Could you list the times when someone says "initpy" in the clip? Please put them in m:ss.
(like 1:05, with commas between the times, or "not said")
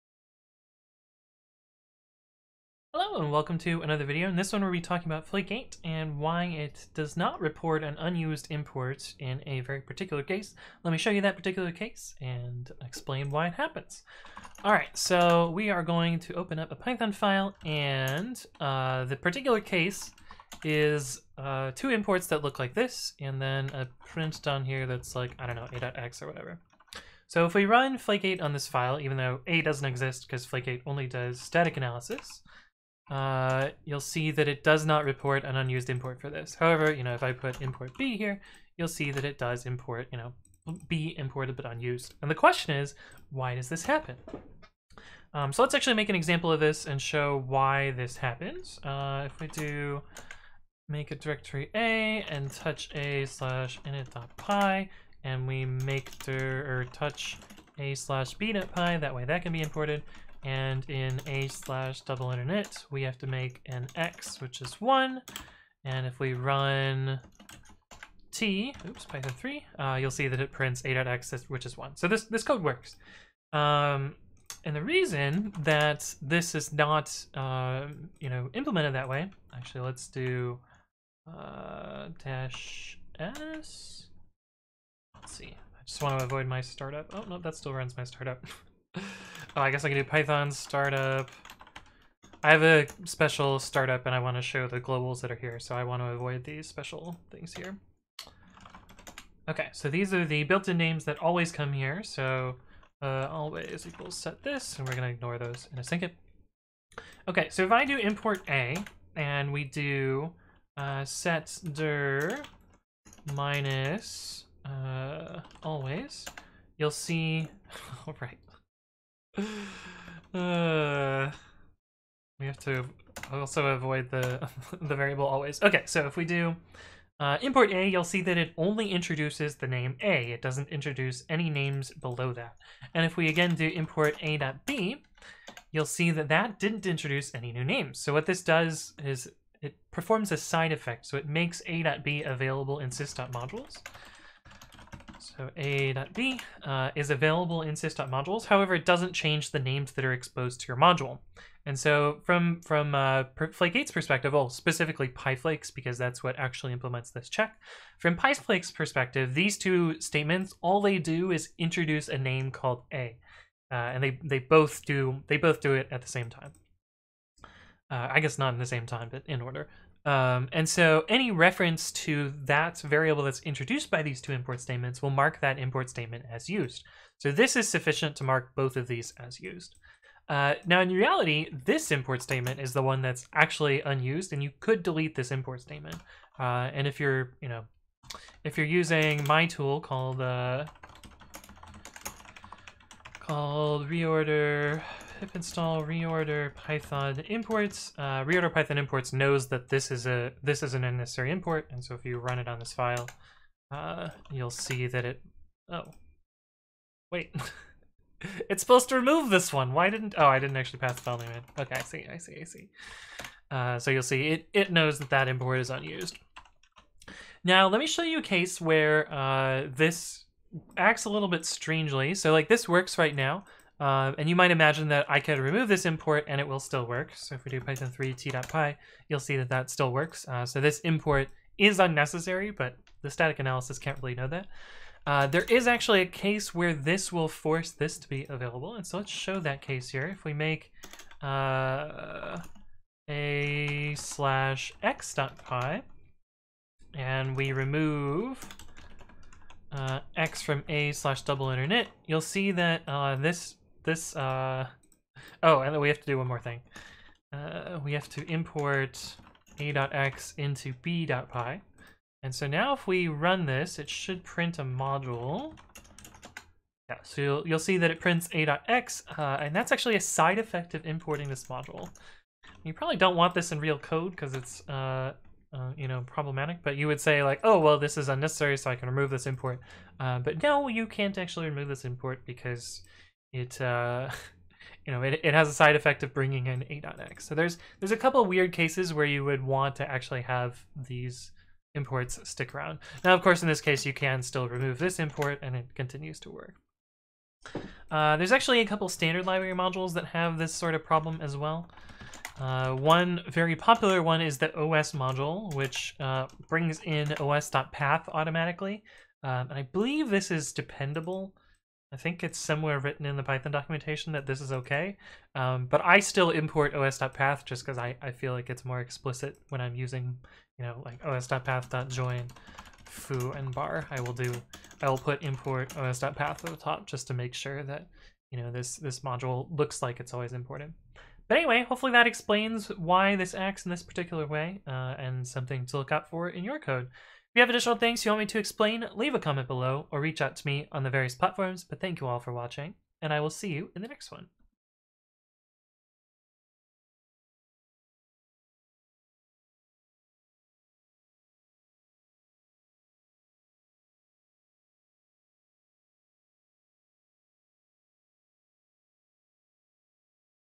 0:53.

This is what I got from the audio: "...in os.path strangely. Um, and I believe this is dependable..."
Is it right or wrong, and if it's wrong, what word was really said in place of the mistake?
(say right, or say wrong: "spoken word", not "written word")
wrong: "automatically", not "strangely".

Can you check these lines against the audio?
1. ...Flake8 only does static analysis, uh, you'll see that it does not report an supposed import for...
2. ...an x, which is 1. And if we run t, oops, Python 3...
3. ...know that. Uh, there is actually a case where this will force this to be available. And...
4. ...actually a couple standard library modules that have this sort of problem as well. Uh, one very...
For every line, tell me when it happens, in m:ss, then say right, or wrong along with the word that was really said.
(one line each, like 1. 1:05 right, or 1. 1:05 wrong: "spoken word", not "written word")
1. 0:30 wrong: "unused", not "supposed"
2. 1:03 right
3. 3:54 right
4. 4:58 right.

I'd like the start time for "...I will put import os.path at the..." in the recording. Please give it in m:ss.
5:24.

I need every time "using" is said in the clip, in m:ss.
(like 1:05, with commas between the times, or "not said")
3:08, 5:19.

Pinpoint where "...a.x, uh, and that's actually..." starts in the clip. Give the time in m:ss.
4:28.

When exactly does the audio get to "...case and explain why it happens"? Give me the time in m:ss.
0:11.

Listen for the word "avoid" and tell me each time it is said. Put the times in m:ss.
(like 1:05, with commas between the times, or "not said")
1:26, 1:36, 2:03.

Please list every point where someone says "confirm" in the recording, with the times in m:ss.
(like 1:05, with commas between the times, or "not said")
not said.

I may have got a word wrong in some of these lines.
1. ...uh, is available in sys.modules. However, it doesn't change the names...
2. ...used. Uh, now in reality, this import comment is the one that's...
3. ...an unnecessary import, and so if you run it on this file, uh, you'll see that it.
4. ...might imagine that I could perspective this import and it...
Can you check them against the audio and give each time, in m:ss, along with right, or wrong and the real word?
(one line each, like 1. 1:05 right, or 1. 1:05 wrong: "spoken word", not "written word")
1. 2:26 right
2. 2:59 wrong: "statement", not "comment"
3. 3:20 right
4. 3:44 wrong: "remove", not "perspective".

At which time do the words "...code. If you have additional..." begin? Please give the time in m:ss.
5:36.